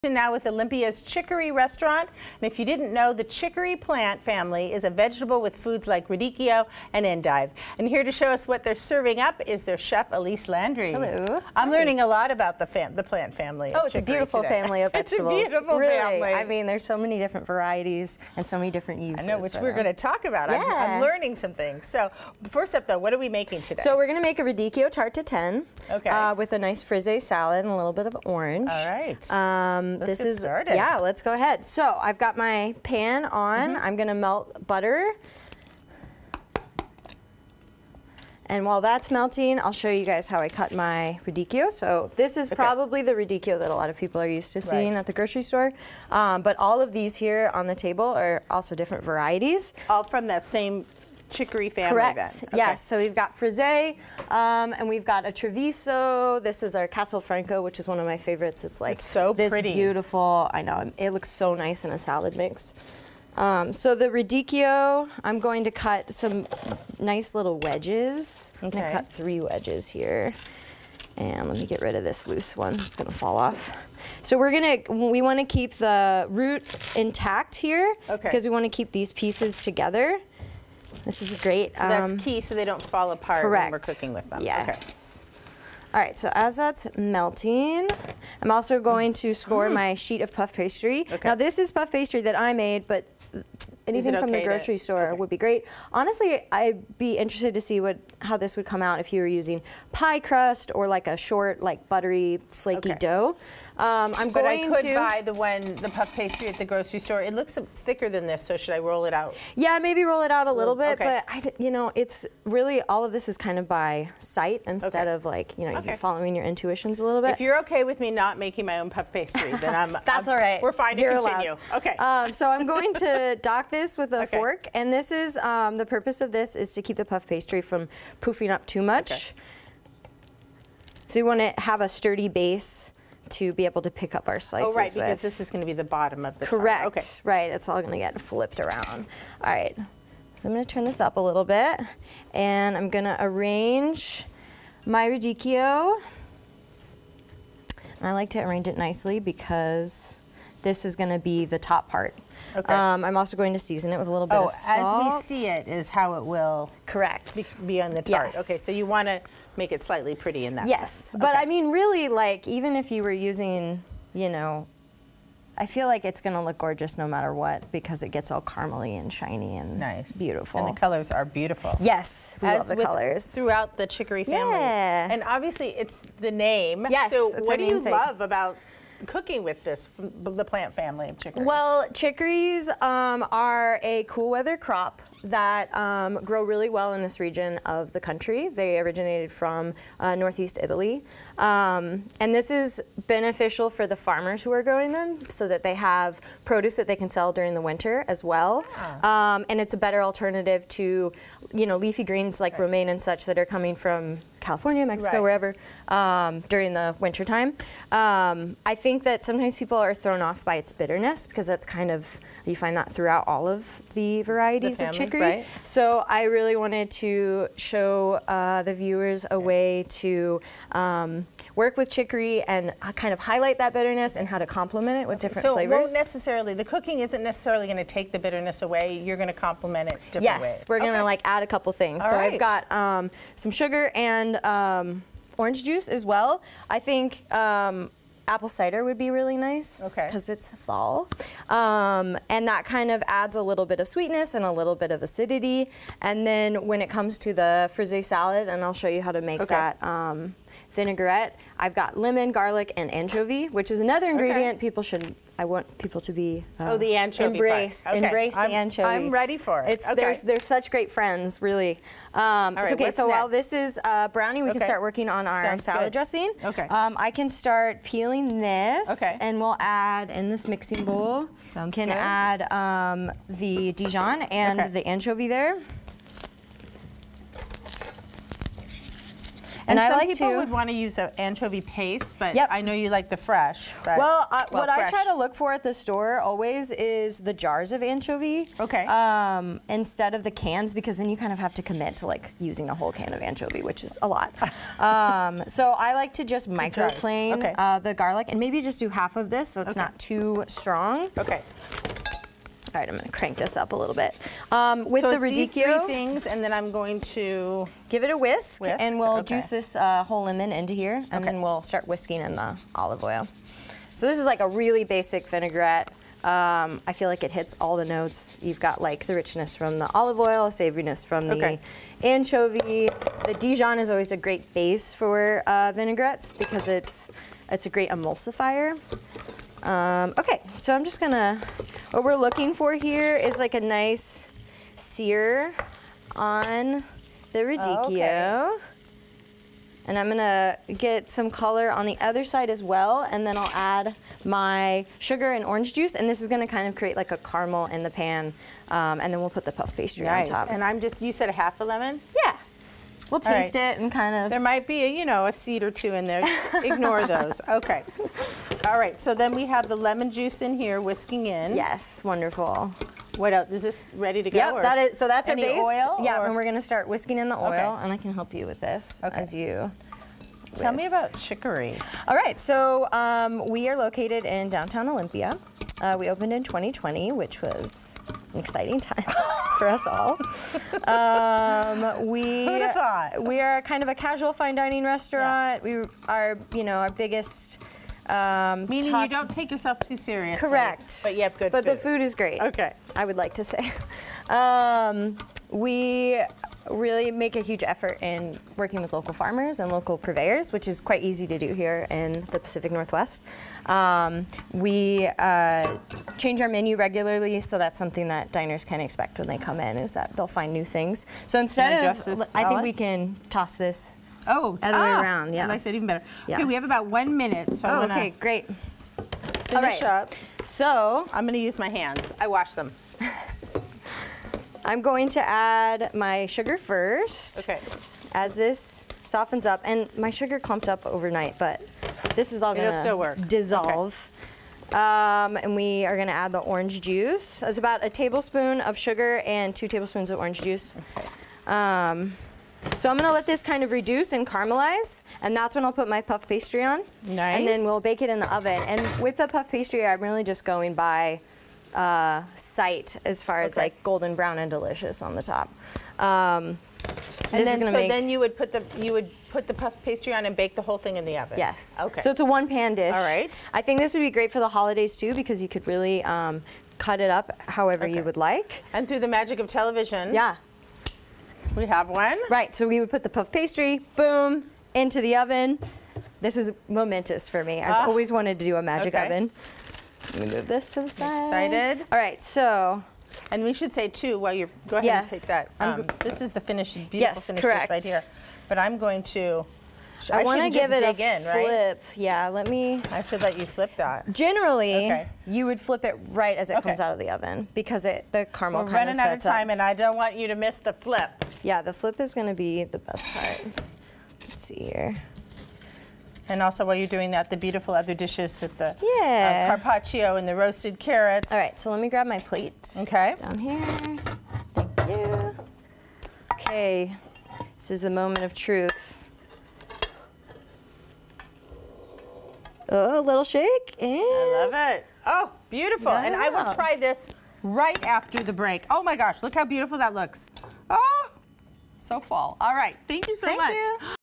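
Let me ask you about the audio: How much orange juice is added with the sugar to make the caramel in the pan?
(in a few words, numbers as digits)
2 tablespoons.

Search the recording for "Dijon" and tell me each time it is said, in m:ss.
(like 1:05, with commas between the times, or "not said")
4:33, 5:23.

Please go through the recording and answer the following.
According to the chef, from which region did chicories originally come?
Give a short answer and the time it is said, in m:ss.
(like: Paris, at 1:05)
Northeast Italy, at 3:10.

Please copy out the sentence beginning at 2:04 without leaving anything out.
fork, and this is um, the purpose of this is to keep the puff pastry from poofing up too much.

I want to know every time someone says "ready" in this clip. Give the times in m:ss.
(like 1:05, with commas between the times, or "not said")
4:19, 6:03.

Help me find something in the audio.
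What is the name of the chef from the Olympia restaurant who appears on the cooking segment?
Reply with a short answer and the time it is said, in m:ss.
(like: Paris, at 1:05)
Elise Landry, at 0:10.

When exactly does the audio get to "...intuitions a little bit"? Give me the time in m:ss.
1:56.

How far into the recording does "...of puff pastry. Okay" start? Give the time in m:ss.
1:30.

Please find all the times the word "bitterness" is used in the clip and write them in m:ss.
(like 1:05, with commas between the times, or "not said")
3:30, 3:43, 3:48.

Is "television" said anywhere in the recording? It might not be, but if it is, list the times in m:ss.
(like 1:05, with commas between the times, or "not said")
7:49.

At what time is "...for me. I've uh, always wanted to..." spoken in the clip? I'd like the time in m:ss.
7:57.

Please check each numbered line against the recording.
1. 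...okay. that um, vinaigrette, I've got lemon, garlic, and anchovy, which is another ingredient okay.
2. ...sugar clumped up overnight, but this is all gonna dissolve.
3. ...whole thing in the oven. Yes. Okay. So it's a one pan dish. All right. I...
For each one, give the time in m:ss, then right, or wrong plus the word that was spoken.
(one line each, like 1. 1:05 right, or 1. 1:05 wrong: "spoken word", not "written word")
1. 4:09 right
2. 7:10 right
3. 7:40 right.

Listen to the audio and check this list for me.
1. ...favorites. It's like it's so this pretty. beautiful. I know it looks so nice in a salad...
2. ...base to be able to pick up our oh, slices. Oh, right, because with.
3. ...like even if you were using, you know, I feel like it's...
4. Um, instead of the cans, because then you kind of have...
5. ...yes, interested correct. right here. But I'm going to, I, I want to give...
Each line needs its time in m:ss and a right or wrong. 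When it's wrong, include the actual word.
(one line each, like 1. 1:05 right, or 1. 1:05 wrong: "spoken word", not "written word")
1. 0:58 right
2. 2:12 right
3. 2:42 right
4. 4:48 right
5. 8:06 wrong: "finished", not "interested".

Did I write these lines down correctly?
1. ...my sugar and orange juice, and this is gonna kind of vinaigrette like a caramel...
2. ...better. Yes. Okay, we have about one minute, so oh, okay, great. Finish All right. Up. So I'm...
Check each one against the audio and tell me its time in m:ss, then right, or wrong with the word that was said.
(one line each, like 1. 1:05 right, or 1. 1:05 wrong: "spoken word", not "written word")
1. 5:44 wrong: "create", not "vinaigrette"
2. 6:55 right.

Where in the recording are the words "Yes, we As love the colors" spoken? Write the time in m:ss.
2:51.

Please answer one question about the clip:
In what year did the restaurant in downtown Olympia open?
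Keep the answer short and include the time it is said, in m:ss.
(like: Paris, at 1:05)
2020, at 6:16.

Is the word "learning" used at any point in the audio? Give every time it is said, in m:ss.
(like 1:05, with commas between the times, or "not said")
0:11, 0:21.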